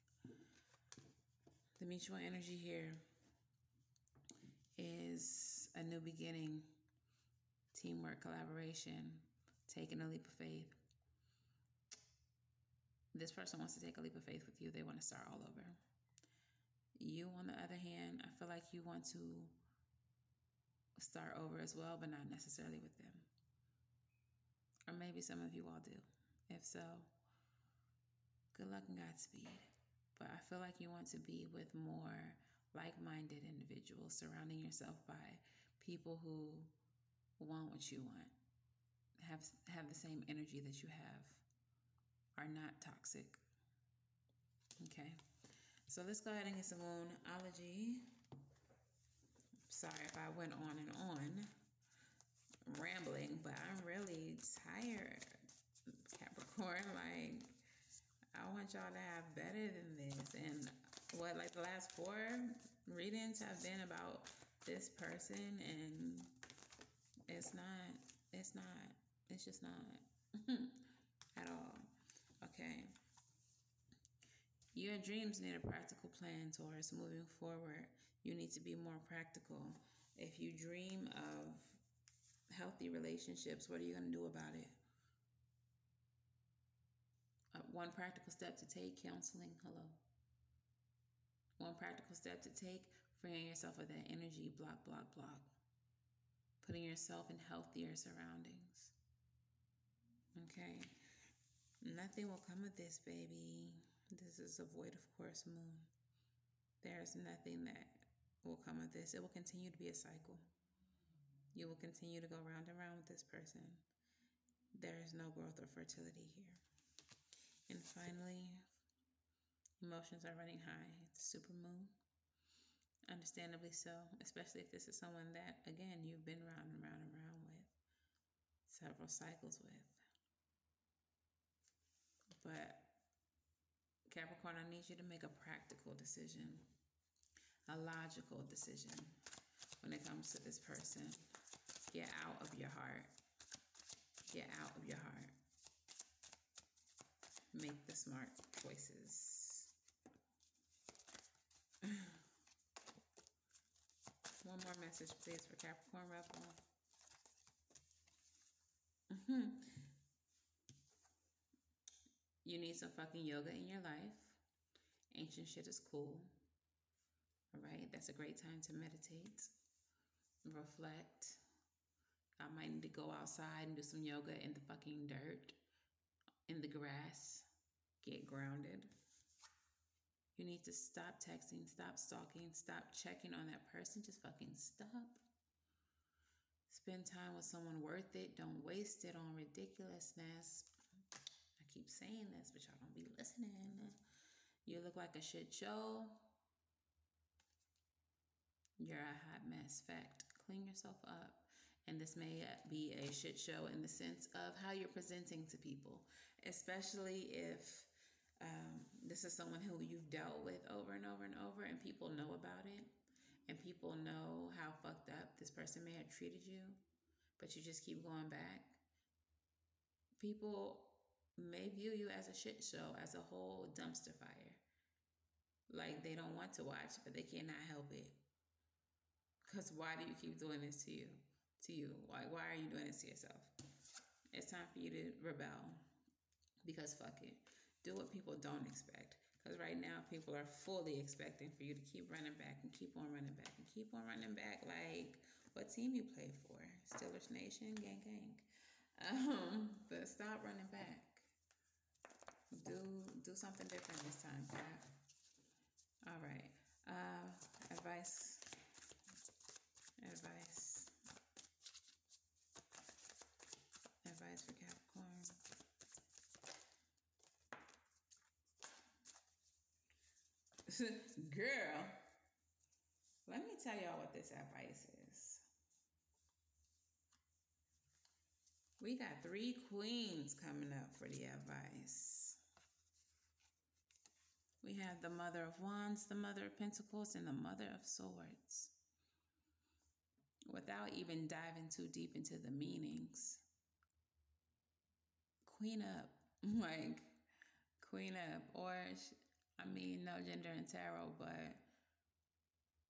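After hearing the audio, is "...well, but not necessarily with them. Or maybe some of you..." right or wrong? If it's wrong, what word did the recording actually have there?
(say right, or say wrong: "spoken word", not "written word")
right.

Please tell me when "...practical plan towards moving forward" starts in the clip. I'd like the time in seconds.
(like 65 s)
75 s.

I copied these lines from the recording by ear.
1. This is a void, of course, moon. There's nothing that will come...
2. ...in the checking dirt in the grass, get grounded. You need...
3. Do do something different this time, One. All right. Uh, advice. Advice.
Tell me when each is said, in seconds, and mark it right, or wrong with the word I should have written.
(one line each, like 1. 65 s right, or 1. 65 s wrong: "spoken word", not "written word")
1. 104 s right
2. 174 s wrong: "fucking", not "checking"
3. 252 s wrong: "Pat", not "One".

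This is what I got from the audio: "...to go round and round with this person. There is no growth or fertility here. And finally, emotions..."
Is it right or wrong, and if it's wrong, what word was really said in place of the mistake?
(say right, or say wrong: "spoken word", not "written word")
right.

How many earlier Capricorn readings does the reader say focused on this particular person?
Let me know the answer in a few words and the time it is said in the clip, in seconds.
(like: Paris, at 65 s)
4, at 61 s.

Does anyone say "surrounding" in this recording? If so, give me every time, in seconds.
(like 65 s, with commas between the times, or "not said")
34 s, 97 s.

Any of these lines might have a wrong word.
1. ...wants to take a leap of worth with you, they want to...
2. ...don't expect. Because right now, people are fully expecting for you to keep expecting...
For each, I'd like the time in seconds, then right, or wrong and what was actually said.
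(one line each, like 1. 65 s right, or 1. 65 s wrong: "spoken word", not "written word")
1. 13 s wrong: "faith", not "worth"
2. 238 s wrong: "running", not "expecting".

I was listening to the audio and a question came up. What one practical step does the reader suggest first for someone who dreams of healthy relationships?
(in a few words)
counseling.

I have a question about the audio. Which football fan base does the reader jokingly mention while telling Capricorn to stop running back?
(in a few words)
Steelers Nation.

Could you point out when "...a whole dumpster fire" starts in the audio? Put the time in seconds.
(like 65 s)
223 s.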